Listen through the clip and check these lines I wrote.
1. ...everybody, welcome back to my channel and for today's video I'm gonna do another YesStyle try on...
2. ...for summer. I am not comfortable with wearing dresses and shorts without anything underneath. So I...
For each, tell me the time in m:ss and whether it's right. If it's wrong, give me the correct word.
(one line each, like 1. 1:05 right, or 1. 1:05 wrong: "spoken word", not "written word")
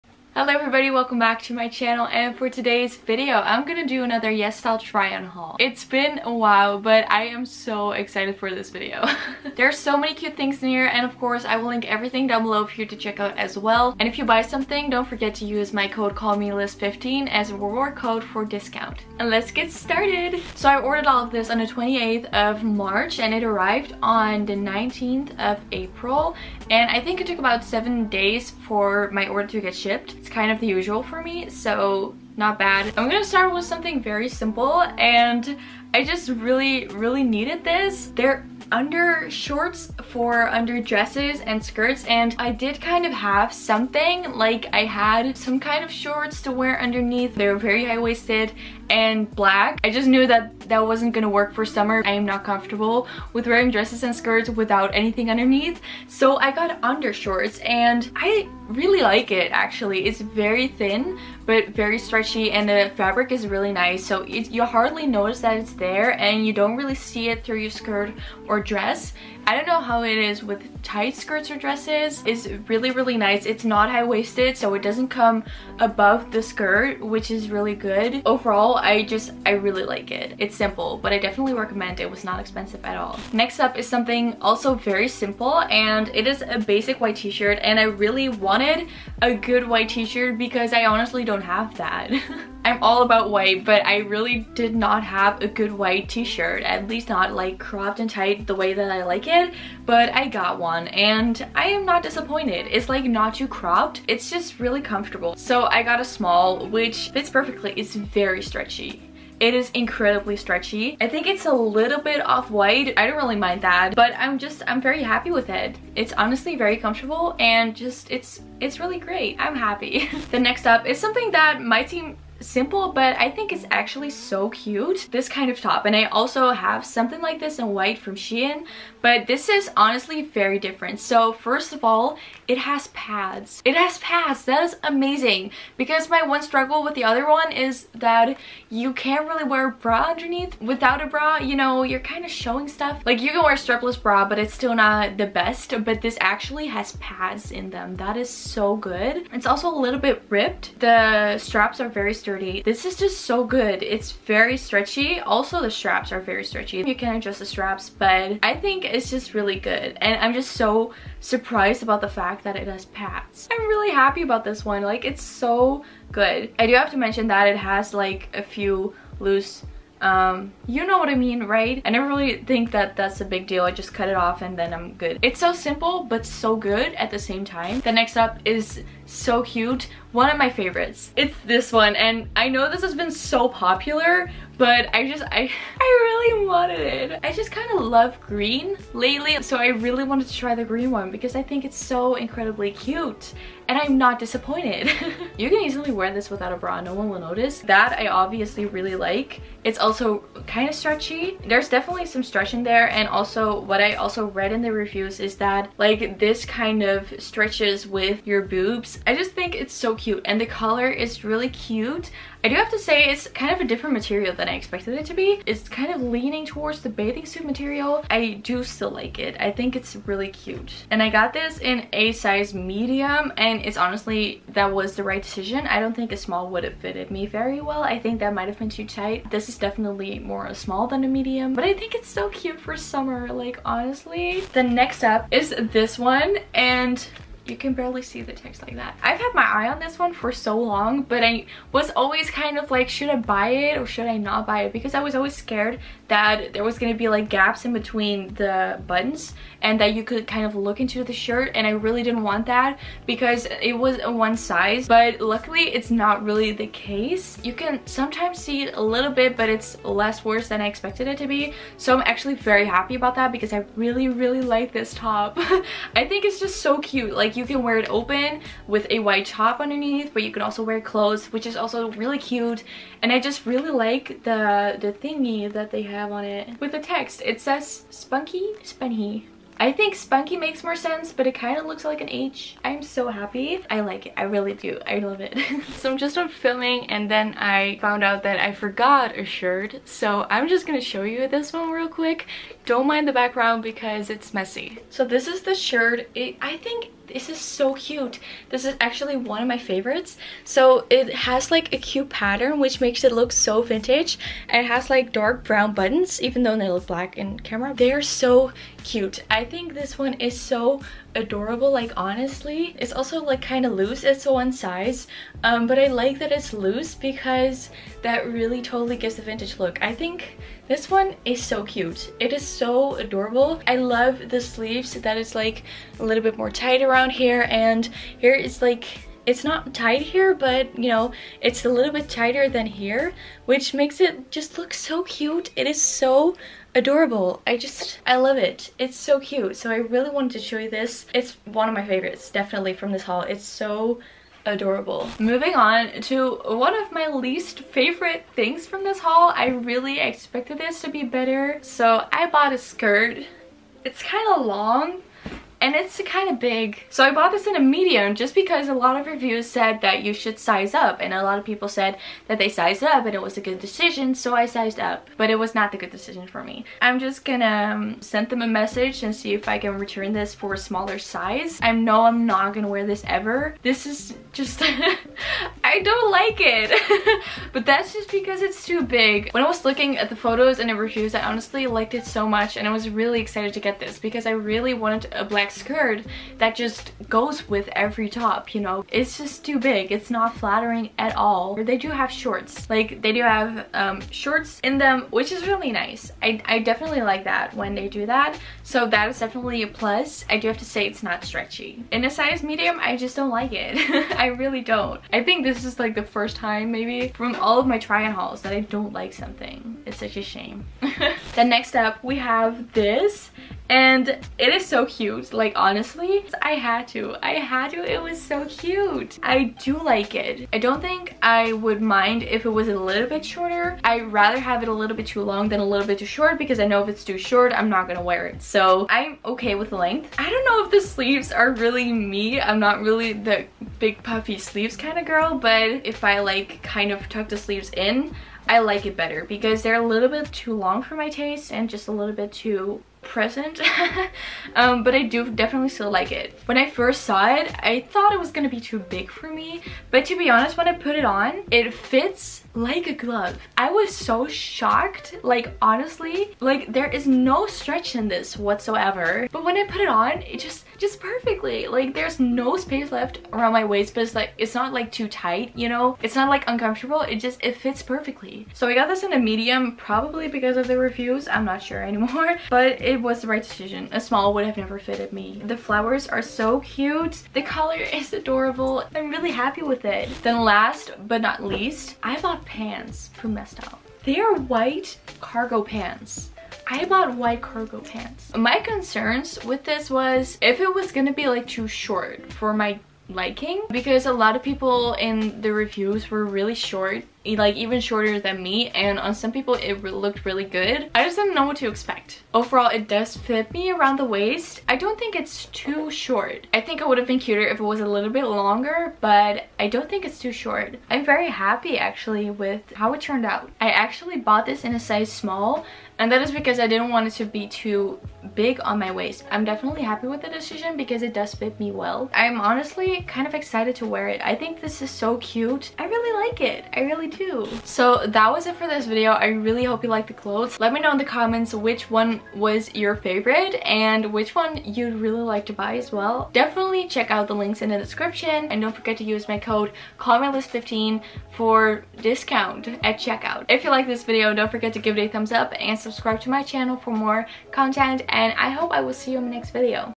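1. 0:00 right
2. 0:51 wrong: "skirts", not "shorts".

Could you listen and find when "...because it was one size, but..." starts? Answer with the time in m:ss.
4:13.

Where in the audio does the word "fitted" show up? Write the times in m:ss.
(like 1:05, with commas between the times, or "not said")
3:46, 7:54.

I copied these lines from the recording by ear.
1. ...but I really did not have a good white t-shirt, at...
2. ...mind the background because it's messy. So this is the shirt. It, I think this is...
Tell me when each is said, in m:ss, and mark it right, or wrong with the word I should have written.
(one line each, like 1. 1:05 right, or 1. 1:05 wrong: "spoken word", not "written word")
1. 1:33 right
2. 4:52 right.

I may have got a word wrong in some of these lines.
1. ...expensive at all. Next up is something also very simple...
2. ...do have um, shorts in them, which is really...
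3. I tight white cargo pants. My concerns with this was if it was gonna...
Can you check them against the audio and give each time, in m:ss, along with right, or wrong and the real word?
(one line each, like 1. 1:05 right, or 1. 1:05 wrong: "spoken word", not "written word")
1. 1:22 right
2. 6:33 right
3. 8:06 wrong: "bought", not "tight".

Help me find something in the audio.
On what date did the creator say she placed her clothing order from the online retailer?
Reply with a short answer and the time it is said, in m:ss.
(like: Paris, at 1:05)
28th of March, at 0:21.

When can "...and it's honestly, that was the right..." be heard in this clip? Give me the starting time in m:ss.
3:43.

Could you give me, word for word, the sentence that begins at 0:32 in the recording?
I'm gonna start with something very simple and I just really, really needed this.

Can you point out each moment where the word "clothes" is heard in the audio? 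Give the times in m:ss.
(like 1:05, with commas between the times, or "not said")
4:30, 8:50.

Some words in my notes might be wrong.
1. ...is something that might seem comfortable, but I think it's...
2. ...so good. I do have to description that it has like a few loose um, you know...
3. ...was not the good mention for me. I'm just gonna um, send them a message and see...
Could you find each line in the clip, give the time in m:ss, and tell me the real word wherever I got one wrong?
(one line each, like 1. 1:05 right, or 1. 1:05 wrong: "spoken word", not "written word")
1. 2:00 wrong: "simple", not "comfortable"
2. 2:45 wrong: "mention", not "description"
3. 6:05 wrong: "decision", not "mention".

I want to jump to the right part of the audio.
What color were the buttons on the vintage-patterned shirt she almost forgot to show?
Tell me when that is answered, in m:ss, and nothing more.
5:05.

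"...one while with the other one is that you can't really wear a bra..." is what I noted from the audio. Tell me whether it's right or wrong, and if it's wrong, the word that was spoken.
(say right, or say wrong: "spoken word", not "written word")
wrong: "struggle", not "while".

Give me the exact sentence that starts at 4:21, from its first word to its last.
So I'm actually very happy about that because I really, really like this top.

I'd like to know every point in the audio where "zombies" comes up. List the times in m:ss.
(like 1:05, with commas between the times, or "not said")
not said.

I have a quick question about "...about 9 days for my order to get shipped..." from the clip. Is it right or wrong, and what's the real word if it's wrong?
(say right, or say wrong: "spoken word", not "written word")
wrong: "7", not "9".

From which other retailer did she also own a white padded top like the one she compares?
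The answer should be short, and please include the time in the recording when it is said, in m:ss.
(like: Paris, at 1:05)
Shein, at 2:08.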